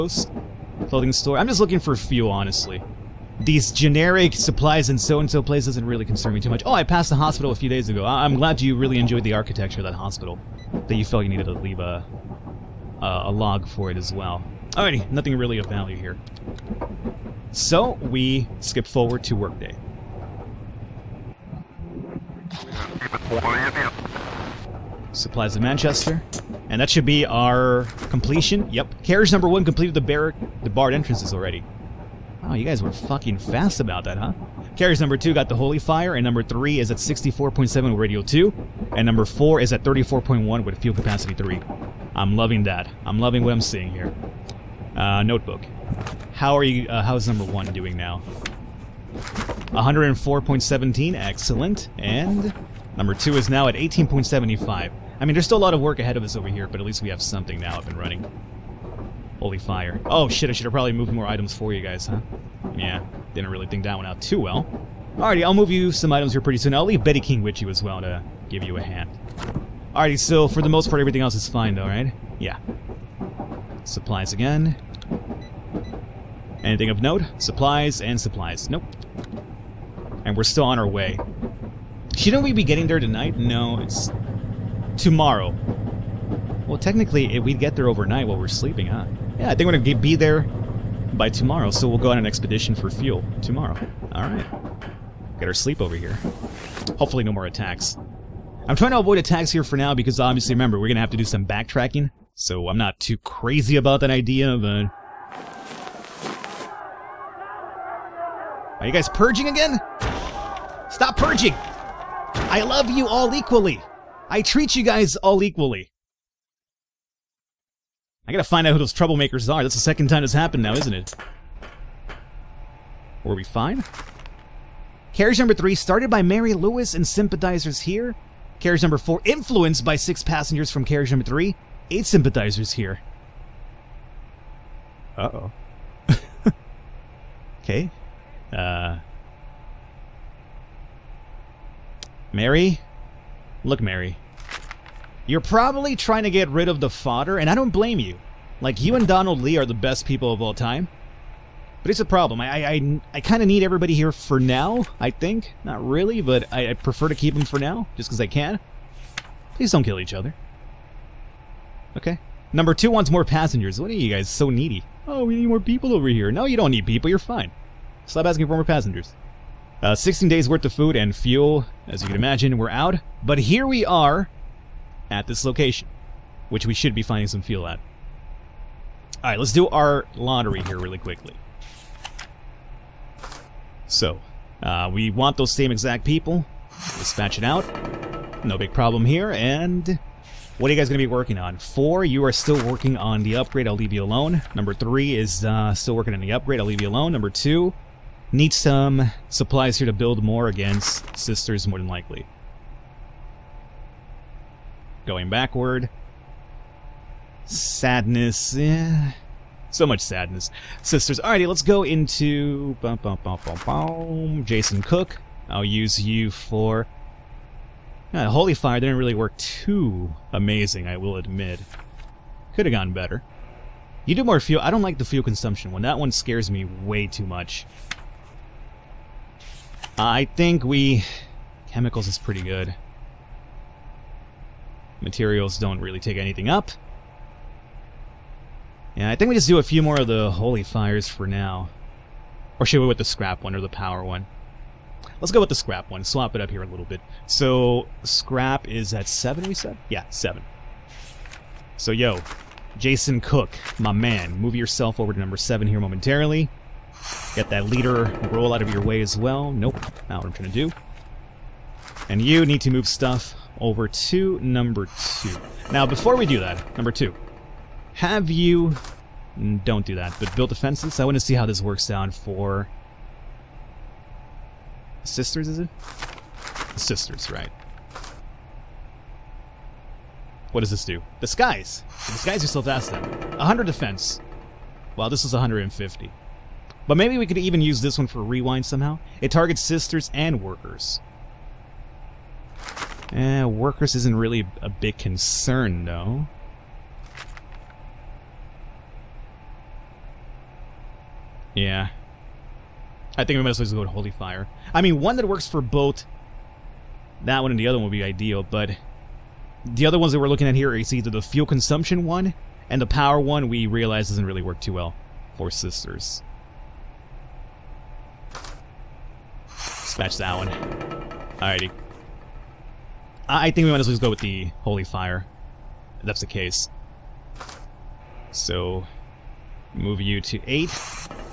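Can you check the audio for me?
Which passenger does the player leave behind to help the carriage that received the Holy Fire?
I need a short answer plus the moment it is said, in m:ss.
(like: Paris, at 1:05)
Betty King, at 1:07.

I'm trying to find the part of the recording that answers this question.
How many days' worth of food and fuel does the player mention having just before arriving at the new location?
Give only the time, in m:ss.
2:49.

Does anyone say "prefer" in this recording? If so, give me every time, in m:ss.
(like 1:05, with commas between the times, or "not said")
2:36.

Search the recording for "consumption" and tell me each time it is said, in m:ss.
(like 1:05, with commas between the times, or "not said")
3:45, 5:11.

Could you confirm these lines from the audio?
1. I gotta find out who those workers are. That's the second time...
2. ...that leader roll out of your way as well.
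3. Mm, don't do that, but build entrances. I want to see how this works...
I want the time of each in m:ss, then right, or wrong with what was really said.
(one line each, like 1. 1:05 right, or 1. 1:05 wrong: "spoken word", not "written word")
1. 1:58 wrong: "troublemakers", not "workers"
2. 4:17 right
3. 4:29 wrong: "defenses", not "entrances".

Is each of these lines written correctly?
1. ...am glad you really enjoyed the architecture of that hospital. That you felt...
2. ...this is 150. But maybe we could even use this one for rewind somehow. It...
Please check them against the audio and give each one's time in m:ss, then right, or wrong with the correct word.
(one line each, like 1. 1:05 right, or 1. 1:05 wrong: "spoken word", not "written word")
1. 0:08 right
2. 4:45 right.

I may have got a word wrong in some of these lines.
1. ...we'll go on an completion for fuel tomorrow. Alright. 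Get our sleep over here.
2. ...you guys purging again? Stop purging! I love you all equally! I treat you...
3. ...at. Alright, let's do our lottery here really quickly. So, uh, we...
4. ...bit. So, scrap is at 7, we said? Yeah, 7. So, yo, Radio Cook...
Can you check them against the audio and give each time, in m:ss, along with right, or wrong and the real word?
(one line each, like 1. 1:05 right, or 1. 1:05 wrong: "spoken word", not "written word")
1. 1:31 wrong: "expedition", not "completion"
2. 1:48 right
3. 2:57 right
4. 4:06 wrong: "Jason", not "Radio".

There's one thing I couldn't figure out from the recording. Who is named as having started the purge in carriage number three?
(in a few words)
Mary Lewis.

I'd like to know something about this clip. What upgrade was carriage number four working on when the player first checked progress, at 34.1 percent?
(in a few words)
Fuel Capacity 3.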